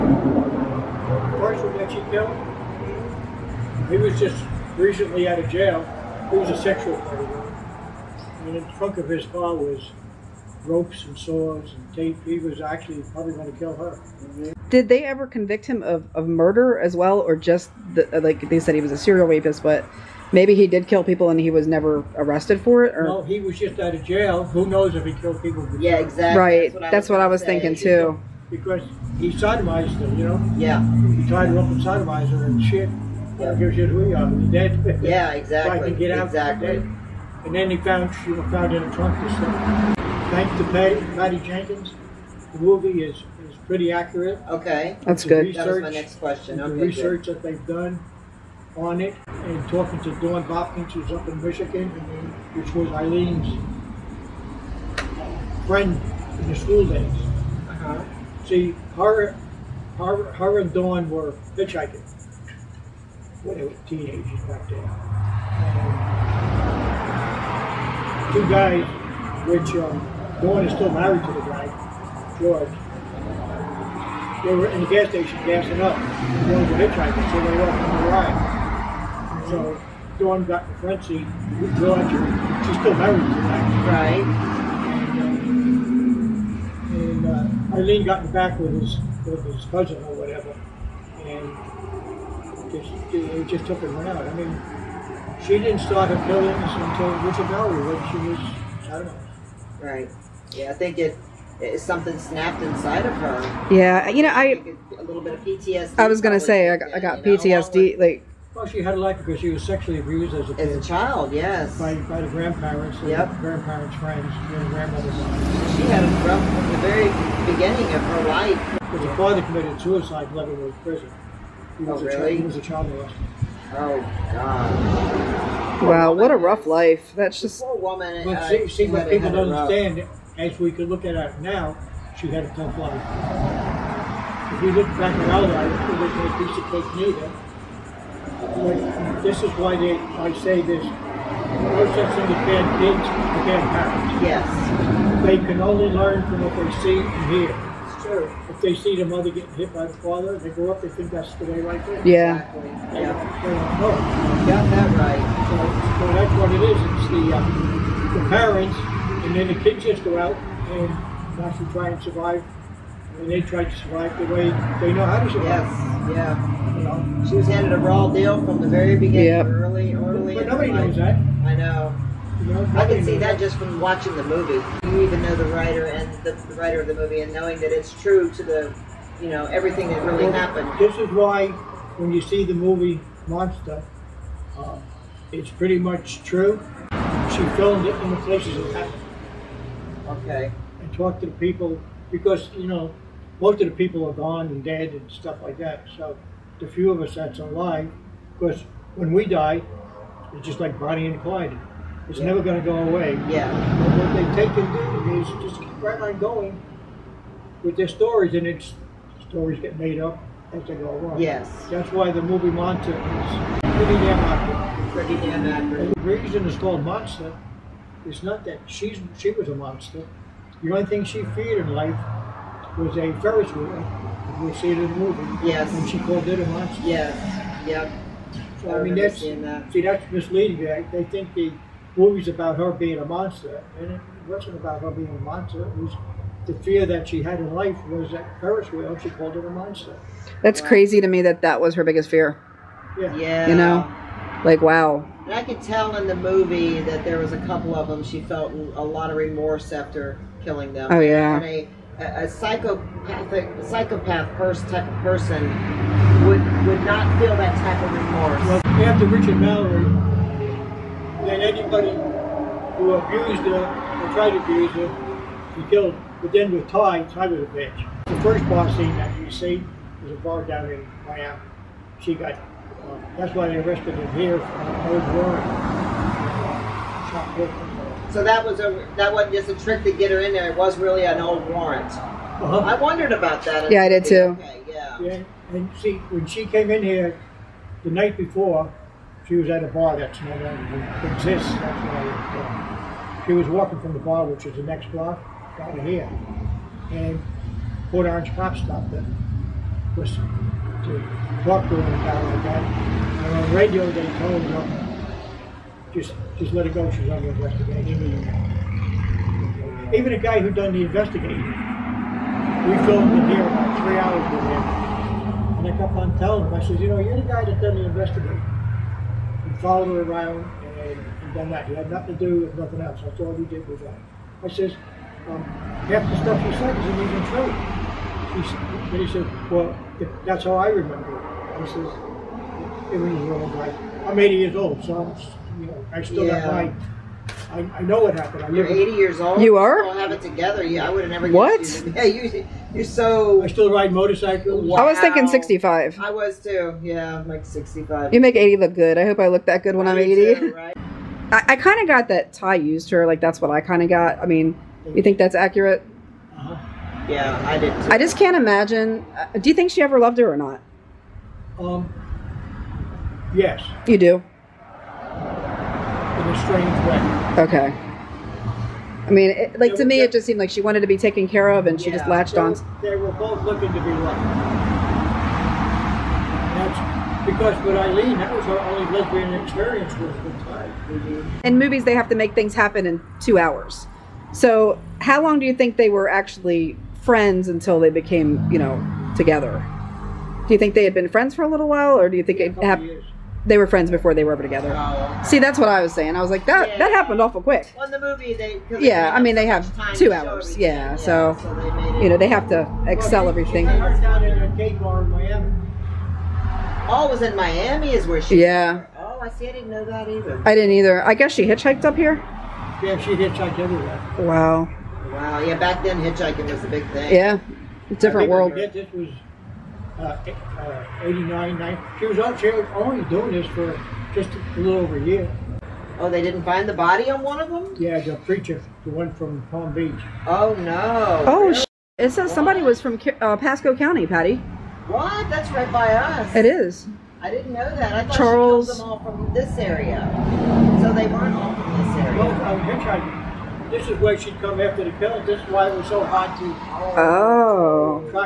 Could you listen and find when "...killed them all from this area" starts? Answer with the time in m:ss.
7:18.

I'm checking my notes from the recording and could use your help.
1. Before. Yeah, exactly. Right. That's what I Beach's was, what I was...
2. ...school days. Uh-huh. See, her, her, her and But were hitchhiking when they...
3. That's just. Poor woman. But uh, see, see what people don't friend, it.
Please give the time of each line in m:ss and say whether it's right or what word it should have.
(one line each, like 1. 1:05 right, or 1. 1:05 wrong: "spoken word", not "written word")
1. 0:25 wrong: "That", not "Beach"
2. 0:56 wrong: "Dawn", not "But"
3. 2:07 wrong: "understand", not "friend".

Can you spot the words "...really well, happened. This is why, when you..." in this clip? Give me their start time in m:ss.
3:00.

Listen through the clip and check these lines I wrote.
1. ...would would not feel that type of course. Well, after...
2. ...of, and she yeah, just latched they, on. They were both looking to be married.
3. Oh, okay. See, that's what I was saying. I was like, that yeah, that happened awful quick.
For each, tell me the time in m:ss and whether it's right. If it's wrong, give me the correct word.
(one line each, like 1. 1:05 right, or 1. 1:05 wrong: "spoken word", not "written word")
1. 4:16 wrong: "remorse", not "course"
2. 6:11 wrong: "loved", not "married"
3. 6:34 right.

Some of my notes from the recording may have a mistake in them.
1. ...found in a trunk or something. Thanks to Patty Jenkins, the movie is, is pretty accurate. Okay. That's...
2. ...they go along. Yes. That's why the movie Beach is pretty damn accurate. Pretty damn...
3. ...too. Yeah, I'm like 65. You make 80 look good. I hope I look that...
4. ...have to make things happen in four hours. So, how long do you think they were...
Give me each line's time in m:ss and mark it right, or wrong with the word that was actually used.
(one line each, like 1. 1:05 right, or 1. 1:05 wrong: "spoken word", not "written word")
1. 0:38 right
2. 3:30 wrong: "Monster", not "Beach"
3. 5:46 right
4. 6:21 wrong: "two", not "four".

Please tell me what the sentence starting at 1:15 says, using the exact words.
They were hitchhiking, so they left on the ride.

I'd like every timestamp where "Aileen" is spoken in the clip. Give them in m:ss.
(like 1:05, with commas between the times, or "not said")
0:52, 1:27, 6:17.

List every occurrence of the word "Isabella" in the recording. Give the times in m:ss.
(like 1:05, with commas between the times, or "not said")
1:37.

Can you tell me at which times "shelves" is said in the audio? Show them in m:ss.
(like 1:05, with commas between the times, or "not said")
not said.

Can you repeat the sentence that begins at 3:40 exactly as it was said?
The only thing she feared in life was a Ferris wheel.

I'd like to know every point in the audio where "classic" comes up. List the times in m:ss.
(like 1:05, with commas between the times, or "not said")
not said.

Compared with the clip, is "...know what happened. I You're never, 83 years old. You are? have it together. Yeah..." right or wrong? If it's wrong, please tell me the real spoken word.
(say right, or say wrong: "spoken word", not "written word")
wrong: "80", not "83".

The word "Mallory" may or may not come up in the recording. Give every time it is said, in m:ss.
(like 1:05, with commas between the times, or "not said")
4:19.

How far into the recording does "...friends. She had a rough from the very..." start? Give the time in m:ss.
1:55.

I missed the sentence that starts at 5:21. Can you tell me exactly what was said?
It had nothing to do with nothing else.